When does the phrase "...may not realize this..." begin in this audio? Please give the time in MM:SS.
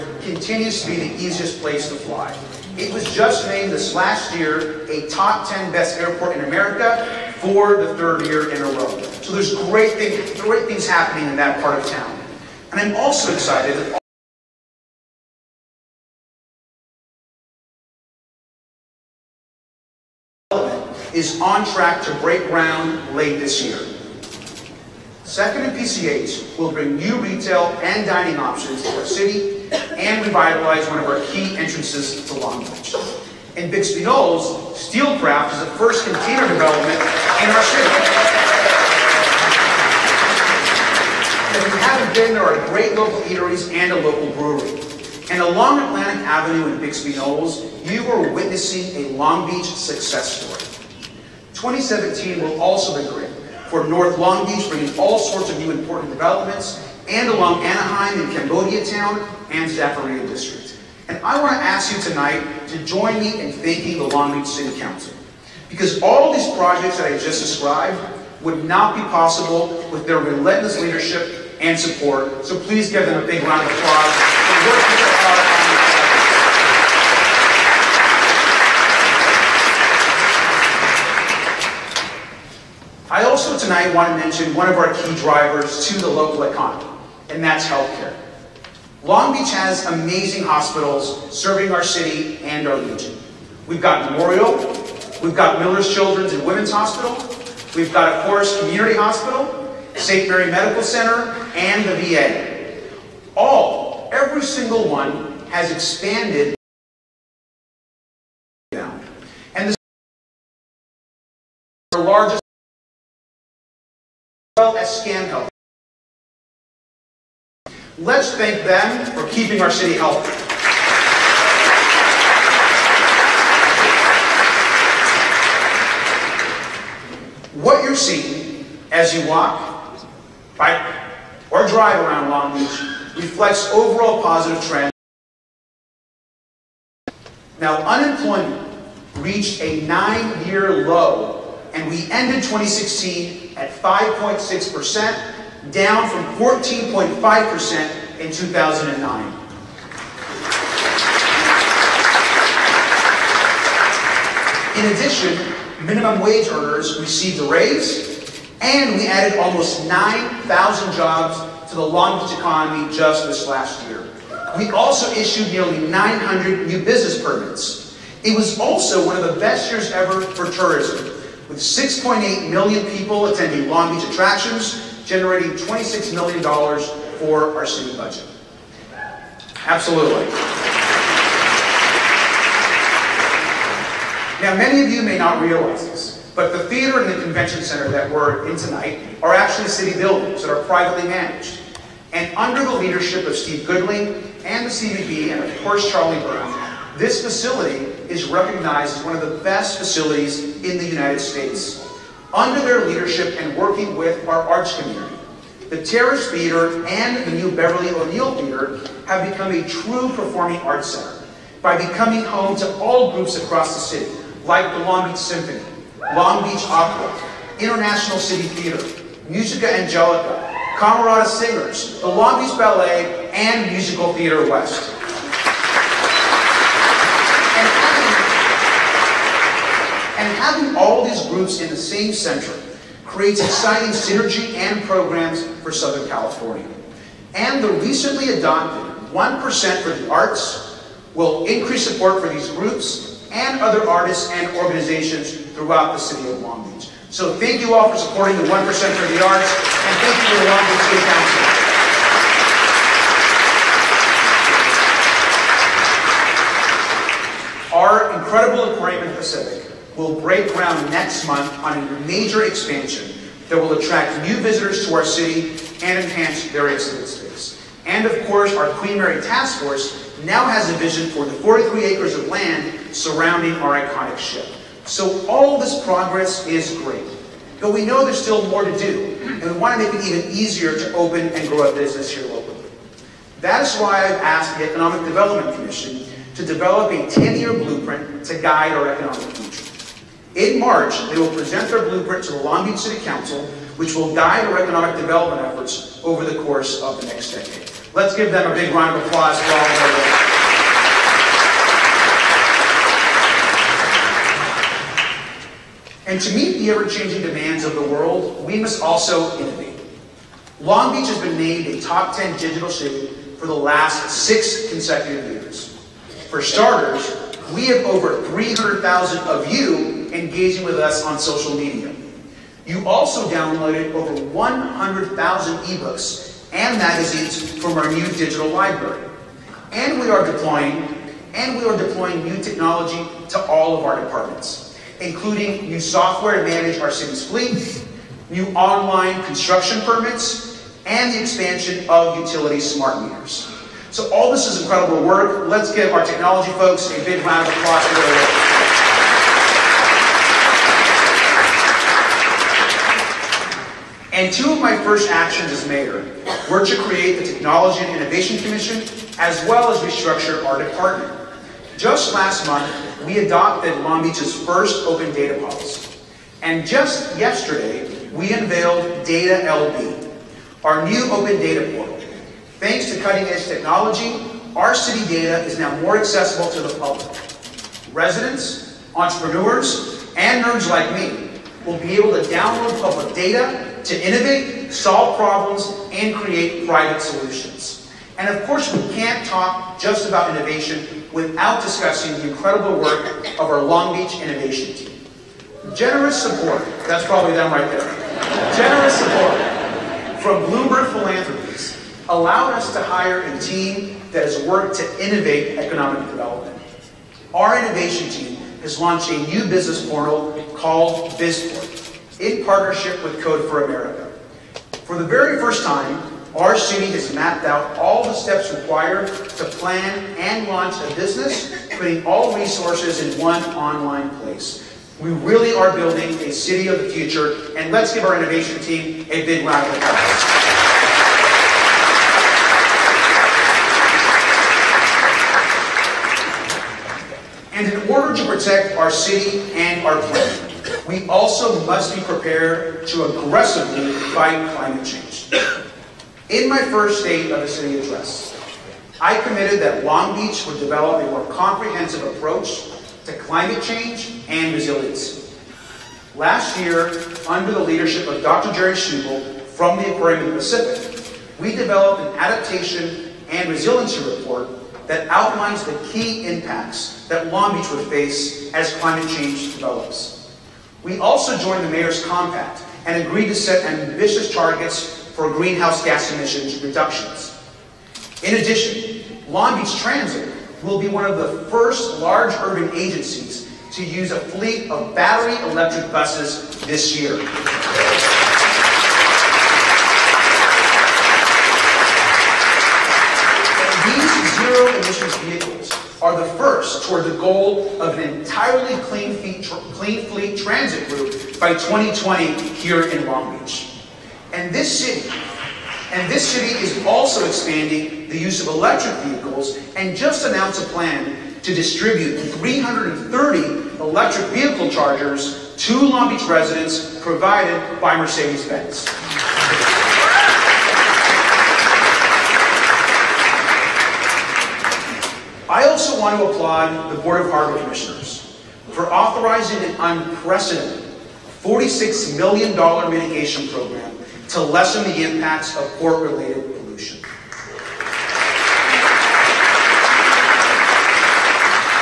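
03:05.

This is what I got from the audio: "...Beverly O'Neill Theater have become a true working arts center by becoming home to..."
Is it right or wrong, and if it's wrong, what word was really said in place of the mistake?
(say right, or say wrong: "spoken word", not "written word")
wrong: "performing", not "working".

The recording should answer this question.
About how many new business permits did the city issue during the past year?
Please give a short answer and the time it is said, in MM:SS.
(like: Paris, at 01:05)
900, at 02:45.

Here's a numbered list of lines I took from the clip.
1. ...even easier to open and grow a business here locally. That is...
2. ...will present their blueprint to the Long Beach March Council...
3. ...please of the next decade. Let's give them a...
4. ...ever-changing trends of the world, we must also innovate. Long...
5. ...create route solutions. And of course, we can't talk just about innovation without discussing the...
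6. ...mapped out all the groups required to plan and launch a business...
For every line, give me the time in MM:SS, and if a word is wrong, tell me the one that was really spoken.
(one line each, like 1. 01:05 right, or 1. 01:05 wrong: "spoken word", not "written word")
1. 04:40 right
2. 04:51 wrong: "City", not "March"
3. 04:56 wrong: "course", not "please"
4. 05:06 wrong: "demands", not "trends"
5. 06:26 wrong: "private", not "route"
6. 06:57 wrong: "steps", not "groups".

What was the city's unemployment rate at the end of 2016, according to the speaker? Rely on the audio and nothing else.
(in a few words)
5.6%.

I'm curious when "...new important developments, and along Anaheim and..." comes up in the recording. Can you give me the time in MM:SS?
00:55.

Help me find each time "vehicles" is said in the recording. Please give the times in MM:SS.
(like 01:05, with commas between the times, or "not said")
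08:29, 08:34.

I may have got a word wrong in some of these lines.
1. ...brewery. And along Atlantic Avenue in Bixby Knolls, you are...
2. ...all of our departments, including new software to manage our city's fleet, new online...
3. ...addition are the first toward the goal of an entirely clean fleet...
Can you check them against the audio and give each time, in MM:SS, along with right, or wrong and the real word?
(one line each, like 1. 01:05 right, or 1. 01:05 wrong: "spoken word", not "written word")
1. 00:44 right
2. 05:33 right
3. 08:14 wrong: "emission", not "addition".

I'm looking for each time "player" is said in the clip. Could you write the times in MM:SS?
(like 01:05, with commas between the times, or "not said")
not said.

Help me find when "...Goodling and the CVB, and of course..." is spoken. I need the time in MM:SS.
03:13.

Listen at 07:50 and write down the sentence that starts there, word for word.
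We also joined the Mayor's Compact and agreed to set ambitious targets for greenhouse gas emissions reductions.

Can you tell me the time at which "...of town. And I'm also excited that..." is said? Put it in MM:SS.
00:11.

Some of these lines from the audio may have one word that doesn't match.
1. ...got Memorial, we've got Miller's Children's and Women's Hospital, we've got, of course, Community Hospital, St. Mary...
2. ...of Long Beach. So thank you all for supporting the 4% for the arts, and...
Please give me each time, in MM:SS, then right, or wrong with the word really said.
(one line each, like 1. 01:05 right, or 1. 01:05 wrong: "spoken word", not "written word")
1. 01:33 right
2. 04:06 wrong: "1", not "4".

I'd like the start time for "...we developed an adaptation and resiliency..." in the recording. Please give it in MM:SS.
07:41.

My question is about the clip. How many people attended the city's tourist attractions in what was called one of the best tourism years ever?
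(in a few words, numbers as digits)
6.8 million.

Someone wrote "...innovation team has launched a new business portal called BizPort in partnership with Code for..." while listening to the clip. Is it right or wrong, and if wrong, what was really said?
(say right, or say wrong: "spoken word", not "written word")
right.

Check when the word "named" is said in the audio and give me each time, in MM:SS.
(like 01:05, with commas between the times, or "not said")
00:03, 05:11.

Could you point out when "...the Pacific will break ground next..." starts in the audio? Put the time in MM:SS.
04:19.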